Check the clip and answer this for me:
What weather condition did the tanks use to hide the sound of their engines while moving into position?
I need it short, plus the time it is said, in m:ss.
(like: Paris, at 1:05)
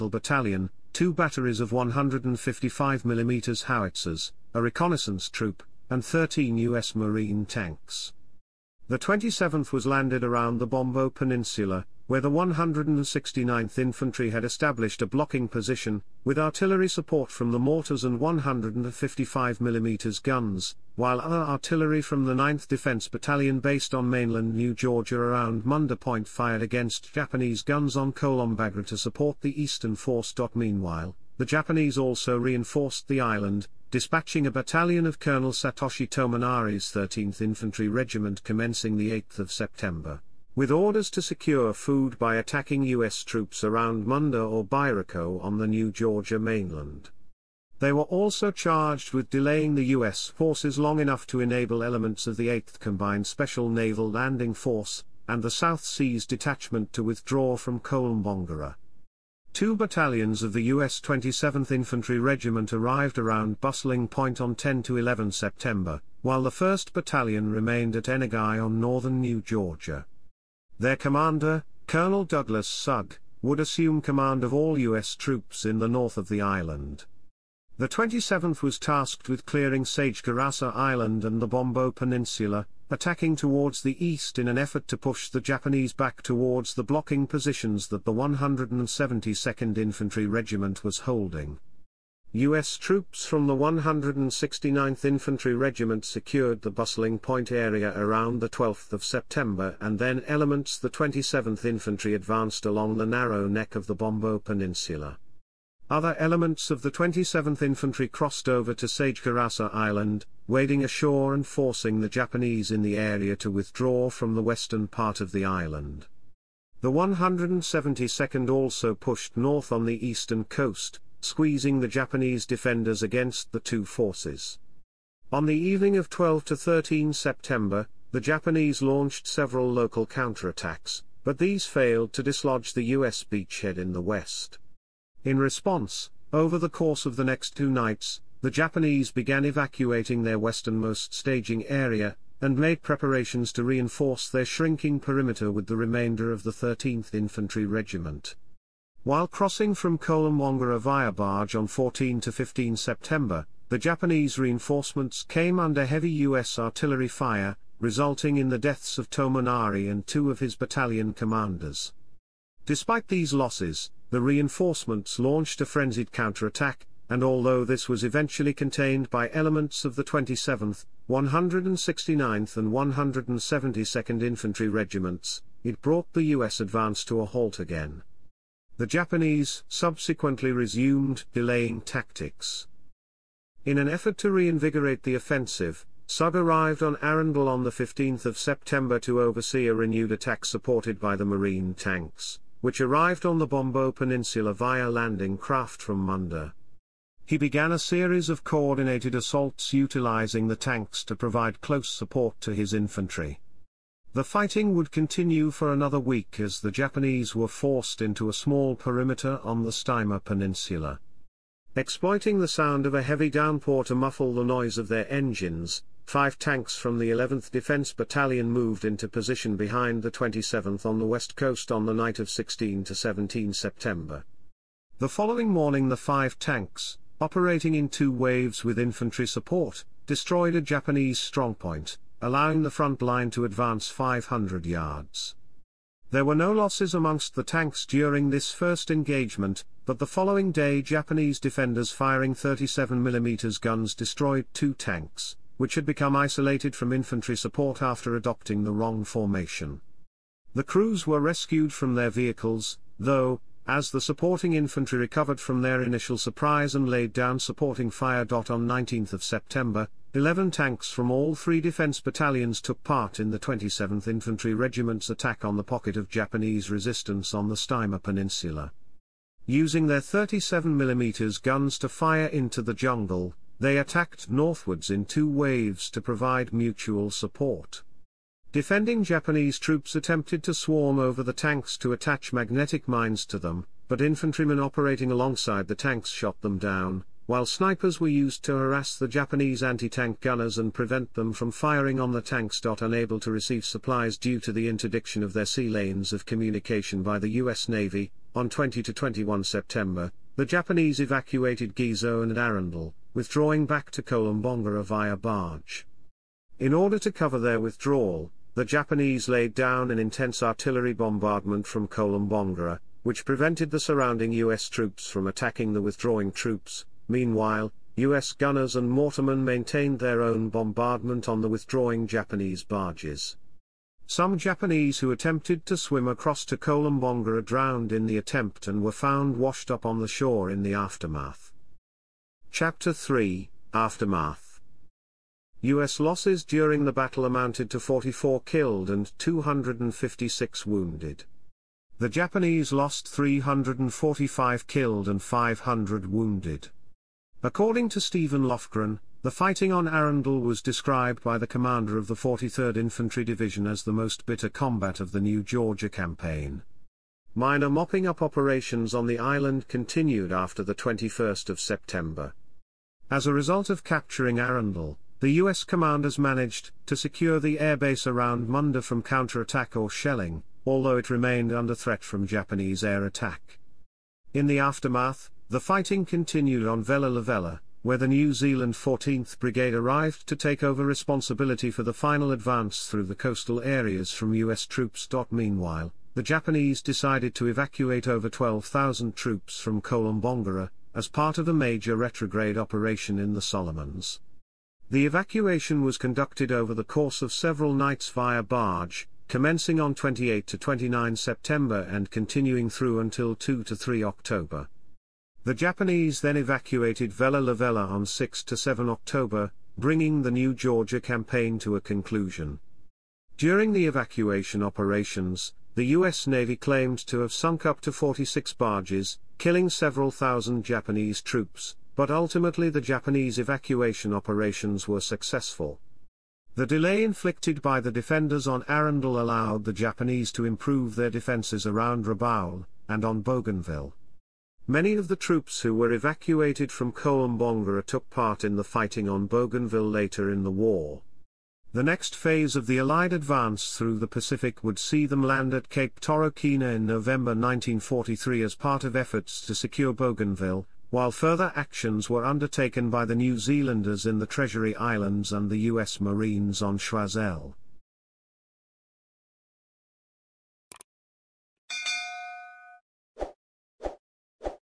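heavy downpour, at 3:33.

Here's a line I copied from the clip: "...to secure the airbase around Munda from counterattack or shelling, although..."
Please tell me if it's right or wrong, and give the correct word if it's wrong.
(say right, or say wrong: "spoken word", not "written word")
right.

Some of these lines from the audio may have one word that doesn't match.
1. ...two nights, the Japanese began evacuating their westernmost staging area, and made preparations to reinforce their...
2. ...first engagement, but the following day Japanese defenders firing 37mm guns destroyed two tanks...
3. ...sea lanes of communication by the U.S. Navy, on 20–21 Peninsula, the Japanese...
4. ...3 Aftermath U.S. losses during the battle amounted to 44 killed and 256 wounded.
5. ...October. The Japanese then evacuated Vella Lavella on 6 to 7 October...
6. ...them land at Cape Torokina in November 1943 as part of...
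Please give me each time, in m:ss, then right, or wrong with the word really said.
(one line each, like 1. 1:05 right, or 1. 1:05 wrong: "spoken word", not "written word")
1. 2:17 right
2. 3:58 right
3. 4:55 wrong: "September", not "Peninsula"
4. 5:32 right
5. 6:44 right
6. 7:25 right.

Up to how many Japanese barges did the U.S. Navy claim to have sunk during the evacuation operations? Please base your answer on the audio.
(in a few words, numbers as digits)
46.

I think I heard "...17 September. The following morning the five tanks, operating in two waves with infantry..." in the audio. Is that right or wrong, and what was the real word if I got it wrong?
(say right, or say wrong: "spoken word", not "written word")
right.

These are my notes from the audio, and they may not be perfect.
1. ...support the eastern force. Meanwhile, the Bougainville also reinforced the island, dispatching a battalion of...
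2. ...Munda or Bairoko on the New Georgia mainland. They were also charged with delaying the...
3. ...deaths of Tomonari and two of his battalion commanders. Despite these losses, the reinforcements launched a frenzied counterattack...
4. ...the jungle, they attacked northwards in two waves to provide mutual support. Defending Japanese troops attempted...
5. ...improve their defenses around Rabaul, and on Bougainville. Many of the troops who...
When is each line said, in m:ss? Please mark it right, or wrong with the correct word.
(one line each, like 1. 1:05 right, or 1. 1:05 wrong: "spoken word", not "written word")
1. 0:28 wrong: "Japanese", not "Bougainville"
2. 0:44 right
3. 2:38 right
4. 4:32 right
5. 7:10 right.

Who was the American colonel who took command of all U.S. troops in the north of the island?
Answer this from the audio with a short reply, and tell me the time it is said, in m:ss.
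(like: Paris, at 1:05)
Douglas Sugg, at 1:12.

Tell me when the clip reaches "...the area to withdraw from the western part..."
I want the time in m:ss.
1:52.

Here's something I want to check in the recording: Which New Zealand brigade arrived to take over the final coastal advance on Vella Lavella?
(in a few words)
14th Brigade.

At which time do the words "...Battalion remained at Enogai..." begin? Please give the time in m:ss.
1:06.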